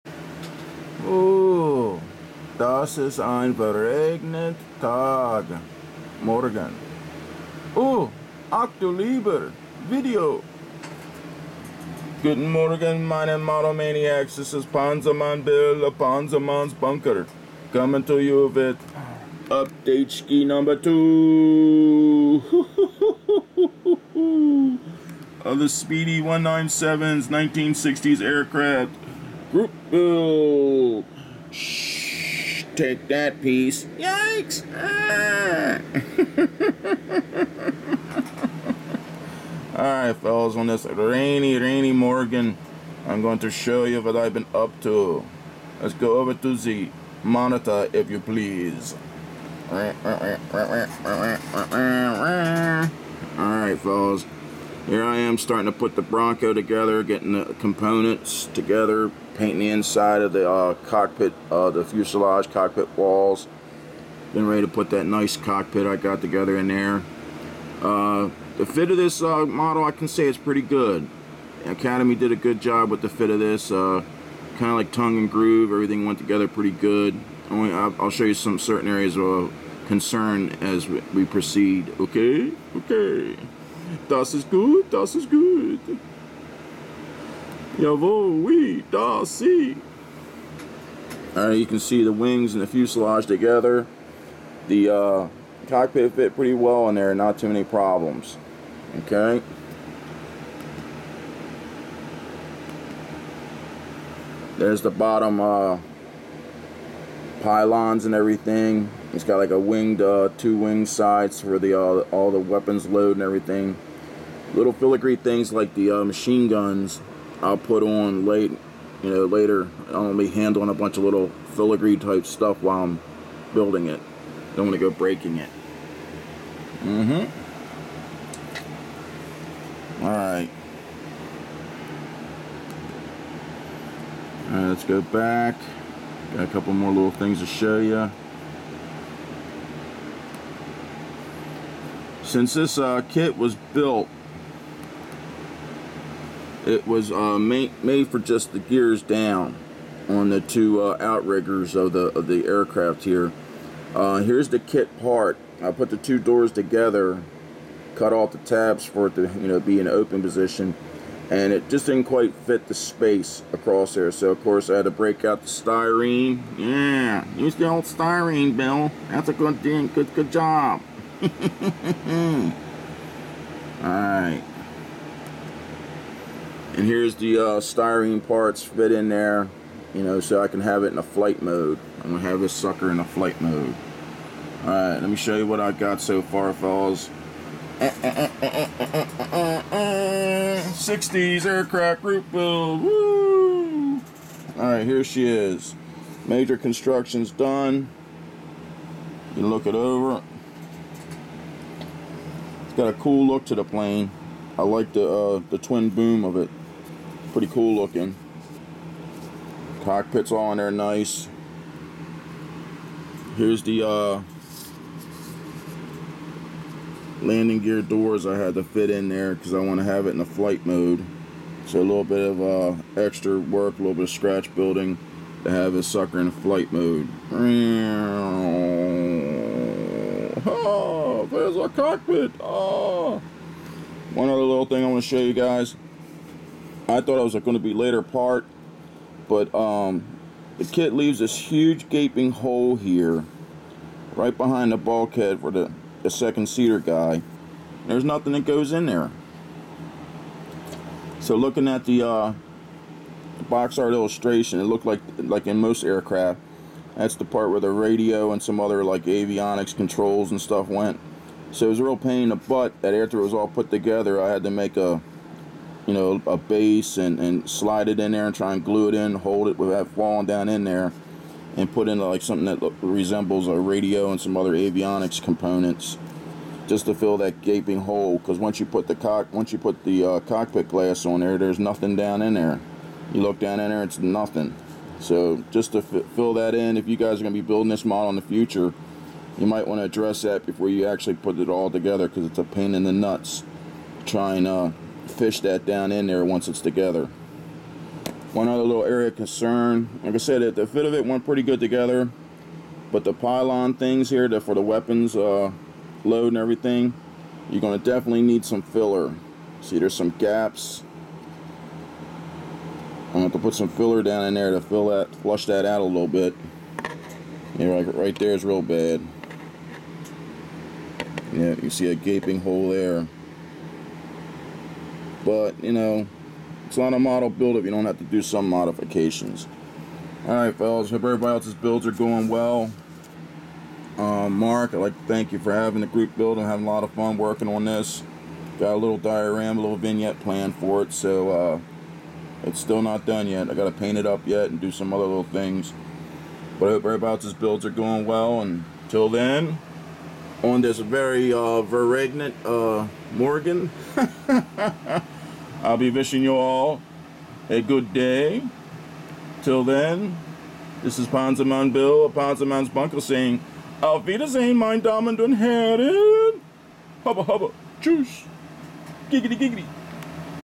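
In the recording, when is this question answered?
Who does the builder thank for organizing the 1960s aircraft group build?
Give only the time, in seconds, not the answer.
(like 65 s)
334 s.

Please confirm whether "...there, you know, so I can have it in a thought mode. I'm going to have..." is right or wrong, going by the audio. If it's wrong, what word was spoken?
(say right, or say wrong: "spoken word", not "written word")
wrong: "flight", not "thought".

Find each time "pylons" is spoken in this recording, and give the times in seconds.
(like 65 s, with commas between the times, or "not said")
107 s, 303 s.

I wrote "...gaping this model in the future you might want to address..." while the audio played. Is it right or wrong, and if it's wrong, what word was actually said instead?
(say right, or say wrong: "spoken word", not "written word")
wrong: "building", not "gaping".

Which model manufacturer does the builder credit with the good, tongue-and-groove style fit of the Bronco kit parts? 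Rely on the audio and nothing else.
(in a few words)
Academy.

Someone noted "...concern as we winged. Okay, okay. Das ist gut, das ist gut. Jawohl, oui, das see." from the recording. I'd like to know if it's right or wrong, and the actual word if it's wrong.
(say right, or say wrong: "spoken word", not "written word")
wrong: "proceed", not "winged".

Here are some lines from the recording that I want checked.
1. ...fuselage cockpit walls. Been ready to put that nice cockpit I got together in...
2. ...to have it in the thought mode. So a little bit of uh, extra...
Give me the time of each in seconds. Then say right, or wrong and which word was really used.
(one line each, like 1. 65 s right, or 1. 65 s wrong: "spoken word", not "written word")
1. 61 s right
2. 219 s wrong: "flight", not "thought".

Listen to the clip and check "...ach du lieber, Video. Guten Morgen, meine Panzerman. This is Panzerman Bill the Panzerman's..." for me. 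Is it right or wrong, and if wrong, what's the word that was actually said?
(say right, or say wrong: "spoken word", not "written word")
wrong: "Motomaniacs", not "Panzerman".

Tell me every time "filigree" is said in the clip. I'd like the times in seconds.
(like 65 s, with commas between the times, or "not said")
114 s, 121 s.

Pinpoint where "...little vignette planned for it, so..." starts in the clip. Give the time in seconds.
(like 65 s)
339 s.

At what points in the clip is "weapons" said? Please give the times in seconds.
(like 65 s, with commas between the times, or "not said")
112 s, 304 s.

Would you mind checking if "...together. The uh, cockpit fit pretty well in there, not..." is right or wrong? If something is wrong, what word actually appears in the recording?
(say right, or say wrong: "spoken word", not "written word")
right.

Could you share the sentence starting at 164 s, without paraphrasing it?
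So of course I had to break out the styrene.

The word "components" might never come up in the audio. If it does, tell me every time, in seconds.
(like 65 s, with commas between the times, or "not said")
57 s, 275 s.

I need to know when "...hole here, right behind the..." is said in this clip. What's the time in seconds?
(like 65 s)
242 s.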